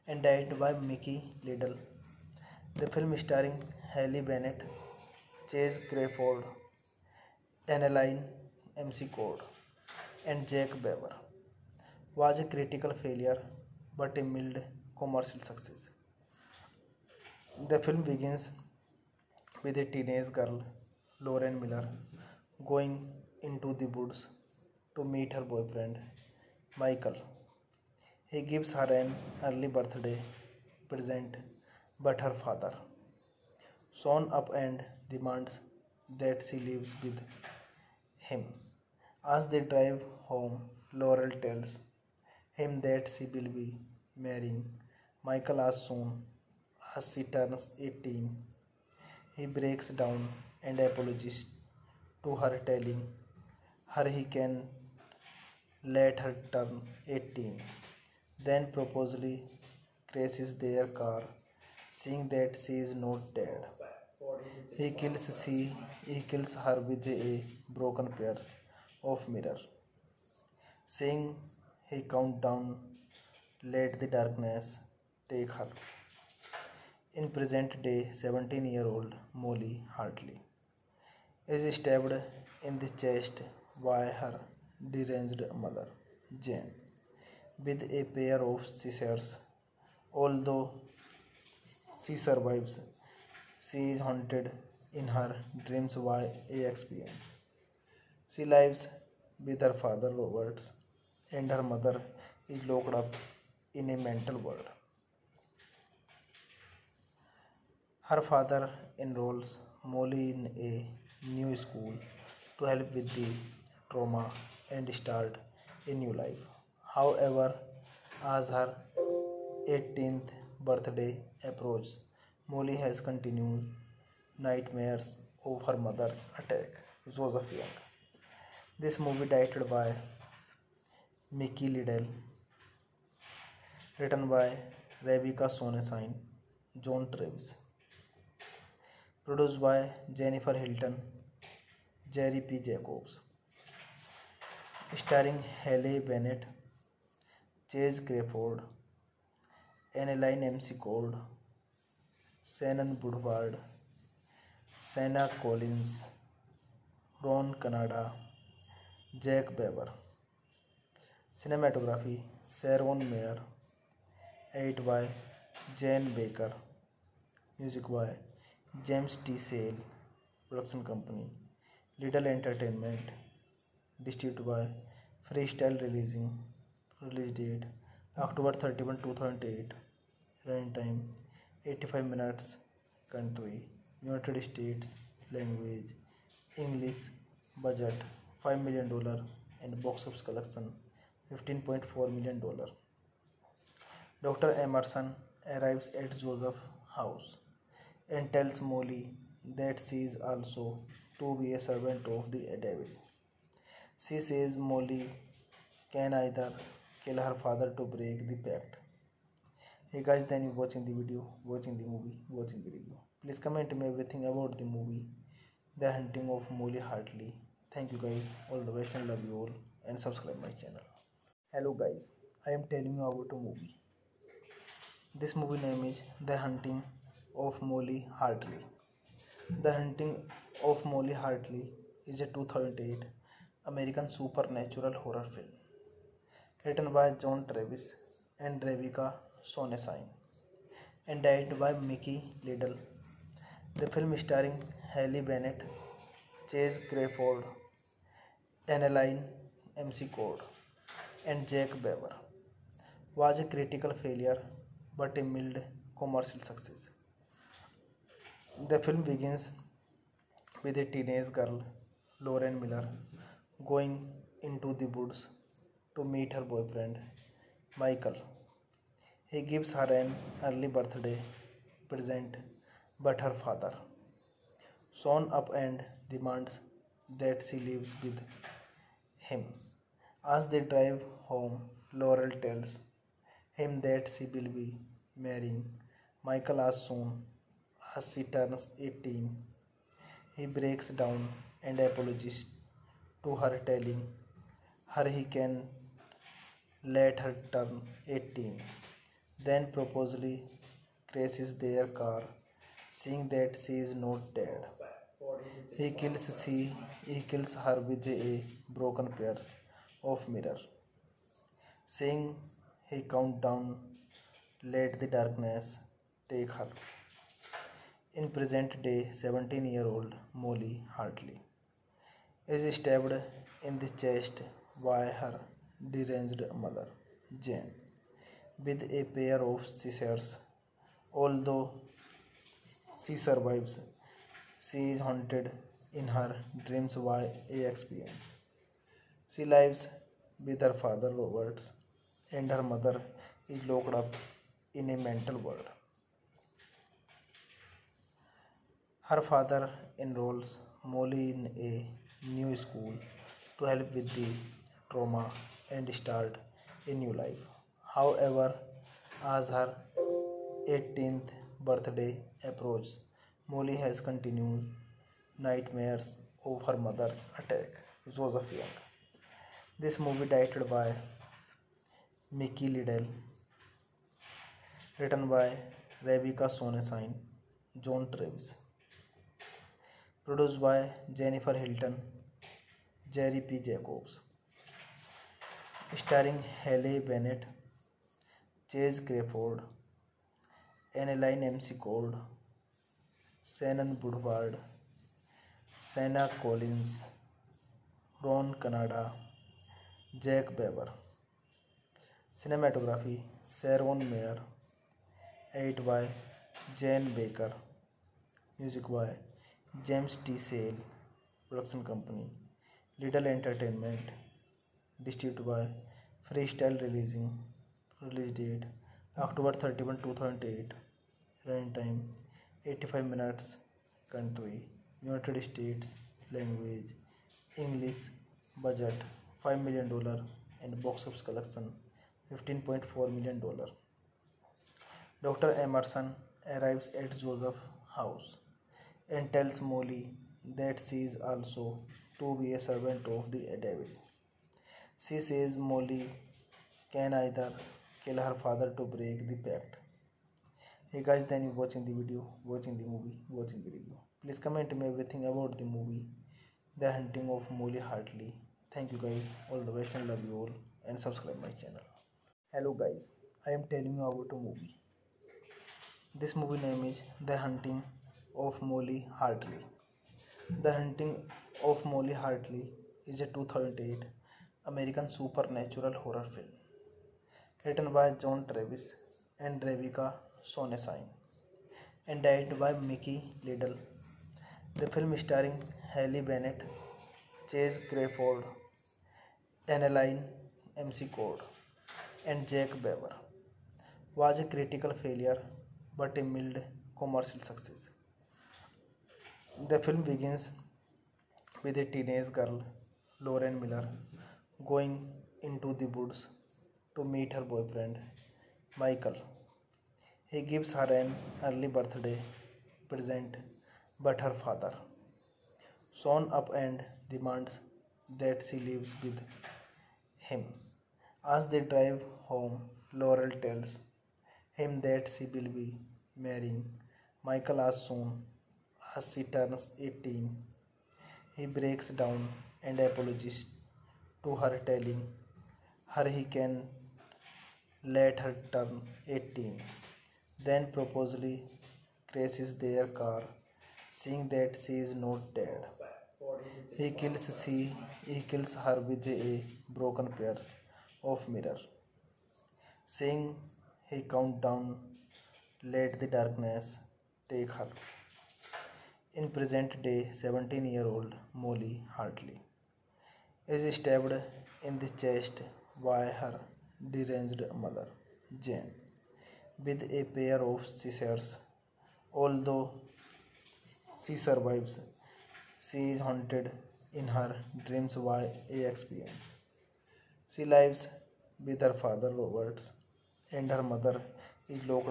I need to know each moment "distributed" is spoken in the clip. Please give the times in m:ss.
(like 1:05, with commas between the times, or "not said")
2:54, 6:55.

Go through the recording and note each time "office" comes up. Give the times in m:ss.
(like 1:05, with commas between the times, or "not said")
3:10, 7:11.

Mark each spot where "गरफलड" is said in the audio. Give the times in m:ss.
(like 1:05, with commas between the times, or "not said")
4:06.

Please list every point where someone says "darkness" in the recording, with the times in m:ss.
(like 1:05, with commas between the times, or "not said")
1:14, 5:15.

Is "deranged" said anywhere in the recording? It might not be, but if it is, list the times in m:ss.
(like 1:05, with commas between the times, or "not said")
1:24, 5:25, 9:26.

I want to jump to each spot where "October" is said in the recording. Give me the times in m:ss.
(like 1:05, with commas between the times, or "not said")
2:58, 6:59.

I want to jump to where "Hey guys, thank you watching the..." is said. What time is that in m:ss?
3:29.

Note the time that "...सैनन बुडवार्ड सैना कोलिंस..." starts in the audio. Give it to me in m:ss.
6:33.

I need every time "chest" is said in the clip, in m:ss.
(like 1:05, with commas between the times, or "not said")
1:23, 5:24, 9:25.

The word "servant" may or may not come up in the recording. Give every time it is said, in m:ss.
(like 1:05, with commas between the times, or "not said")
3:21, 7:22.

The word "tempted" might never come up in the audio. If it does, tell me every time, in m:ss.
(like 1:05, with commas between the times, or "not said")
not said.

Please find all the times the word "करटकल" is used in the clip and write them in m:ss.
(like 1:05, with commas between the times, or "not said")
0:12, 4:13, 8:14.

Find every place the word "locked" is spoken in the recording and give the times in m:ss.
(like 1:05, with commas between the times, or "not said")
1:42, 5:43.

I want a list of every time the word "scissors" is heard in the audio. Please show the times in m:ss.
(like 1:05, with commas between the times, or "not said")
1:28, 5:29, 9:30.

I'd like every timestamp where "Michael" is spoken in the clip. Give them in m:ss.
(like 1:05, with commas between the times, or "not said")
0:26, 0:45, 4:27, 4:46, 8:28, 8:47.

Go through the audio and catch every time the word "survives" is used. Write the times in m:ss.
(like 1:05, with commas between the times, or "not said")
1:32, 5:33, 9:34.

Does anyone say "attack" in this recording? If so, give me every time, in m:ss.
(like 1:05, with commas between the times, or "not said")
2:06, 6:07.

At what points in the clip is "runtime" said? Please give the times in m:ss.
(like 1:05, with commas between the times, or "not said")
3:00, 7:01.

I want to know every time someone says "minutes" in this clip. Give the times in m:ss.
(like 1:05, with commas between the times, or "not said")
3:02, 7:03.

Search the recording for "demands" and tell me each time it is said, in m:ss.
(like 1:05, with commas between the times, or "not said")
0:35, 4:36, 8:37.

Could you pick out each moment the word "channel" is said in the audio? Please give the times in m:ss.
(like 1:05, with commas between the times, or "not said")
3:40, 7:41.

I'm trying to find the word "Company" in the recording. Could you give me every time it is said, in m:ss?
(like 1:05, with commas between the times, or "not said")
2:50, 6:51.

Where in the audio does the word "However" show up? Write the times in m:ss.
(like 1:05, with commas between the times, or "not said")
1:56, 5:57.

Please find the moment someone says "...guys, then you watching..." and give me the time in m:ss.
7:31.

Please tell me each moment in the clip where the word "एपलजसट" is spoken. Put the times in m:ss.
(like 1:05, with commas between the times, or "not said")
8:52.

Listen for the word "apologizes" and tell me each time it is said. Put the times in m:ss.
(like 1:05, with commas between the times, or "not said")
0:50, 4:51.